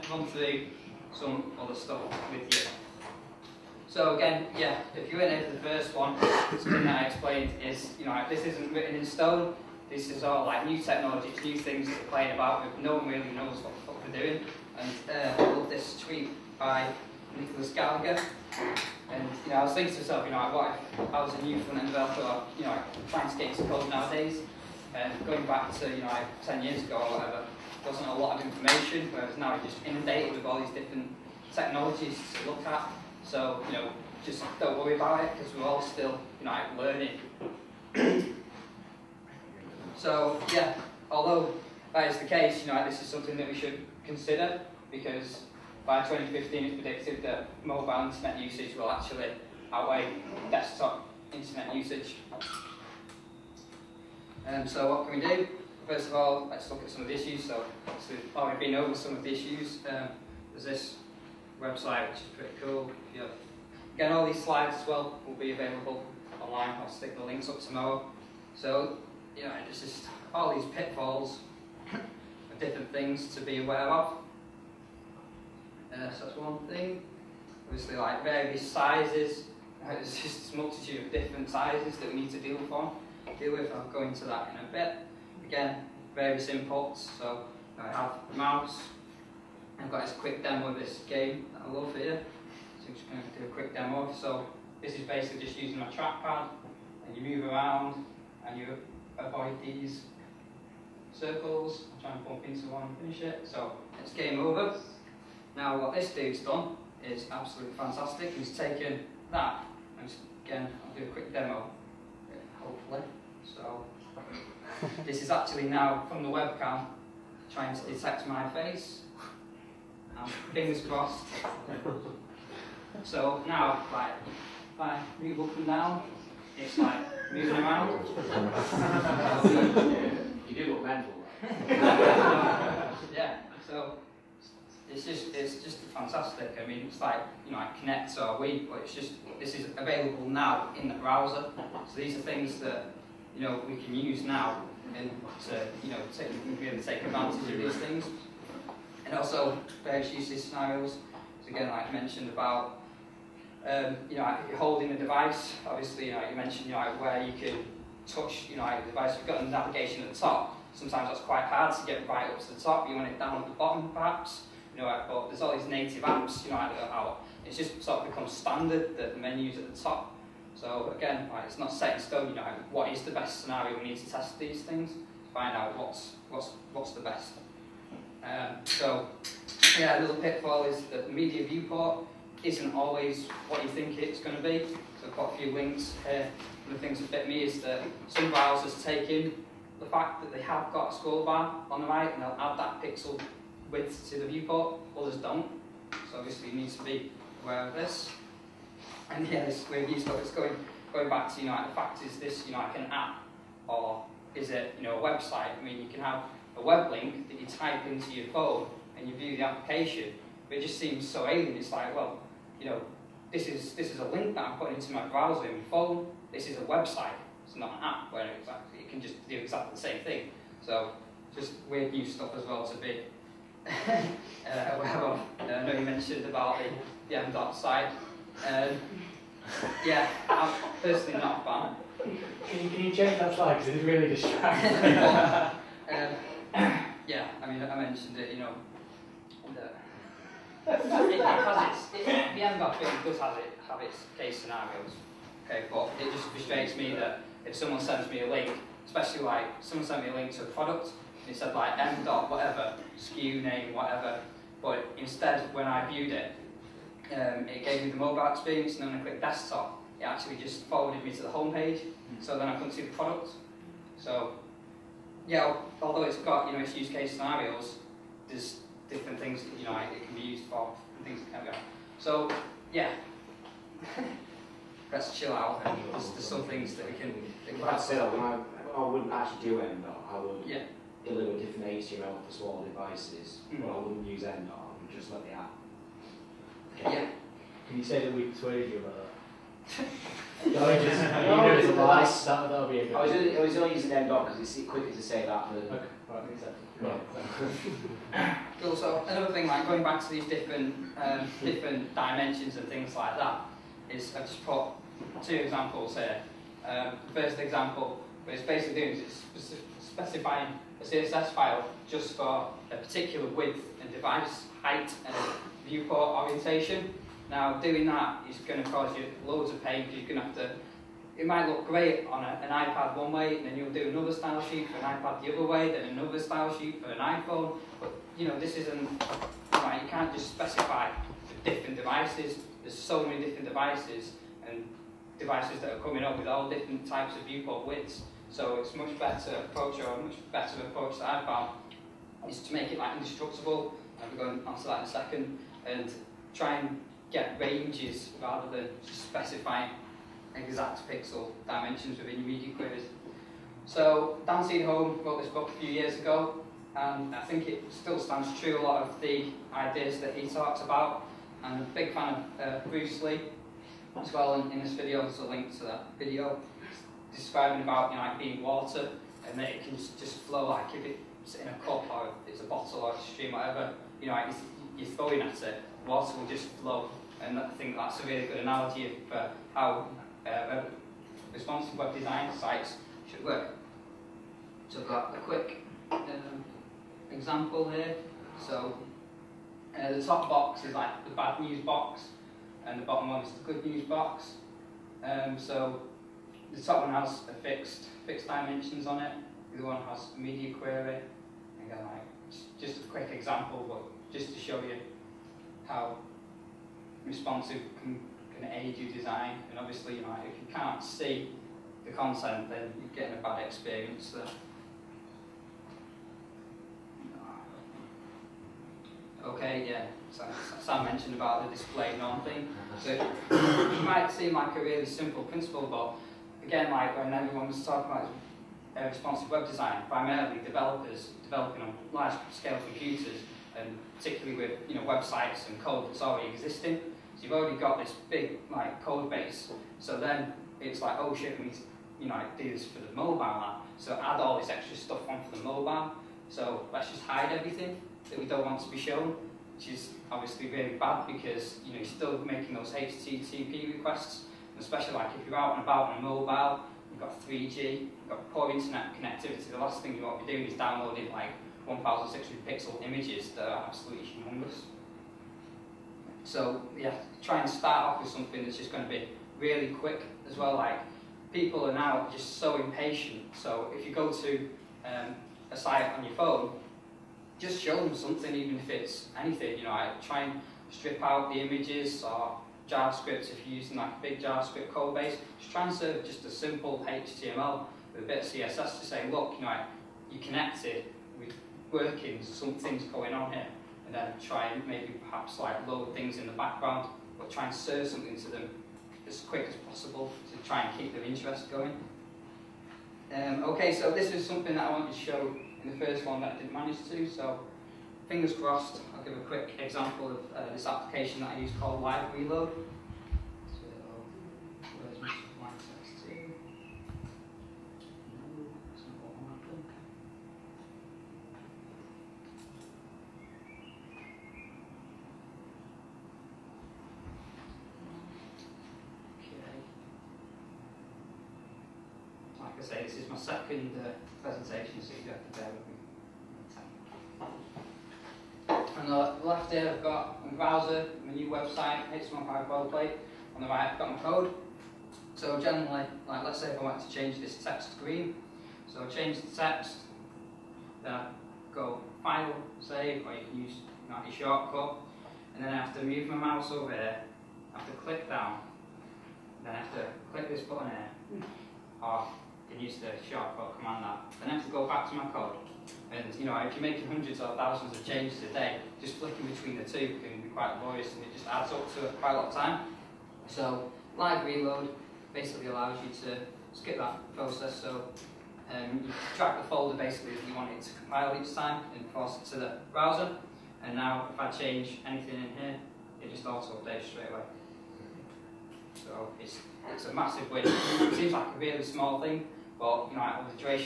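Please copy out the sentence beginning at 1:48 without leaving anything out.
He's taken that, and again, I'll do a quick demo, hopefully.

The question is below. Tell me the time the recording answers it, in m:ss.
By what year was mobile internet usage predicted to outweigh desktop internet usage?
0:46.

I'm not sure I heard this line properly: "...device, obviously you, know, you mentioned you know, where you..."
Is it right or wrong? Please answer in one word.
right.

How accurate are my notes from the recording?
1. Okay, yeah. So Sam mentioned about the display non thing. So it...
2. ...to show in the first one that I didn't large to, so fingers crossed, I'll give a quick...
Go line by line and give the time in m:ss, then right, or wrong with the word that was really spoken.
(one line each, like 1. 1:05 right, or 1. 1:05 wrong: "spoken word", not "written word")
1. 6:59 right
2. 8:24 wrong: "manage", not "large".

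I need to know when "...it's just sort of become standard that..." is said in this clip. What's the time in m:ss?
2:47.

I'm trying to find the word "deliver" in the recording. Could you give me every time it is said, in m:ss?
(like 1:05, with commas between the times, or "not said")
4:41.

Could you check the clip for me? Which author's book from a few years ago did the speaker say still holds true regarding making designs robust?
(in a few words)
Dan Cederholm.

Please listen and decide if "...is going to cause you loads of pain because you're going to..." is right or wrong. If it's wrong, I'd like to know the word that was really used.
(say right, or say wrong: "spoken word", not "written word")
right.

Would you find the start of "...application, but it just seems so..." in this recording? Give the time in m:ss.
3:29.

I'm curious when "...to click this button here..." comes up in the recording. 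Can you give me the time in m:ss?
9:19.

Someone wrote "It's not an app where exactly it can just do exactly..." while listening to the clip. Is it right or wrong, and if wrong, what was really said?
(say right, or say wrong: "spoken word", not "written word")
right.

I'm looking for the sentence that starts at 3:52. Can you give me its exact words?
Can you, can you that slide because it's really distracting.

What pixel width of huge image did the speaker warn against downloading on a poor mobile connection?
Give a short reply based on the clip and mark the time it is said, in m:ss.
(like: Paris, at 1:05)
1,600 pixels, at 7:41.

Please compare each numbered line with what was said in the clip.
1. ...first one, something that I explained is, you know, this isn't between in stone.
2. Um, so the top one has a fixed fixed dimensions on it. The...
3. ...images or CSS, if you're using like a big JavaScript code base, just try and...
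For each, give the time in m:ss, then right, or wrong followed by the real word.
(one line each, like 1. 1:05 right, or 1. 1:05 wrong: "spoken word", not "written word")
1. 0:05 wrong: "written", not "between"
2. 6:35 right
3. 8:01 wrong: "JavaScript", not "CSS".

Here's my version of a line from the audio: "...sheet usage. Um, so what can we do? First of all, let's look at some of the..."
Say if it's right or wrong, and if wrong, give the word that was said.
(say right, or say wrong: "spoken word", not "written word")
wrong: "internet", not "sheet".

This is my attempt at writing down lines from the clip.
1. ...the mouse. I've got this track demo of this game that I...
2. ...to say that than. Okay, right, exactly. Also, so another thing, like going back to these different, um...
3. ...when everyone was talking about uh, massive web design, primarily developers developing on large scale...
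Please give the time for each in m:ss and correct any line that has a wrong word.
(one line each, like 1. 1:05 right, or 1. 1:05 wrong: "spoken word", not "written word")
1. 1:28 wrong: "quick", not "track"
2. 4:54 right
3. 7:06 wrong: "responsive", not "massive".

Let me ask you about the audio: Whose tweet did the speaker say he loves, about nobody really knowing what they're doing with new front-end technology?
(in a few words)
Nicolas Gallagher.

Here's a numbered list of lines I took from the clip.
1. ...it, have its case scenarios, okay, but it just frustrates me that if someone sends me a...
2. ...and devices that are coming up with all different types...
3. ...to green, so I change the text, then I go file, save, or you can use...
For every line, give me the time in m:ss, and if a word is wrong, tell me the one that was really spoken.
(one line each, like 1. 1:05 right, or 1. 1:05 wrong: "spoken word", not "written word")
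1. 4:03 right
2. 5:34 right
3. 9:07 right.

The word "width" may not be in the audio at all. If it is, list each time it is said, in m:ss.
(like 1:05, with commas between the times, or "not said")
3:13, 5:13, 5:37.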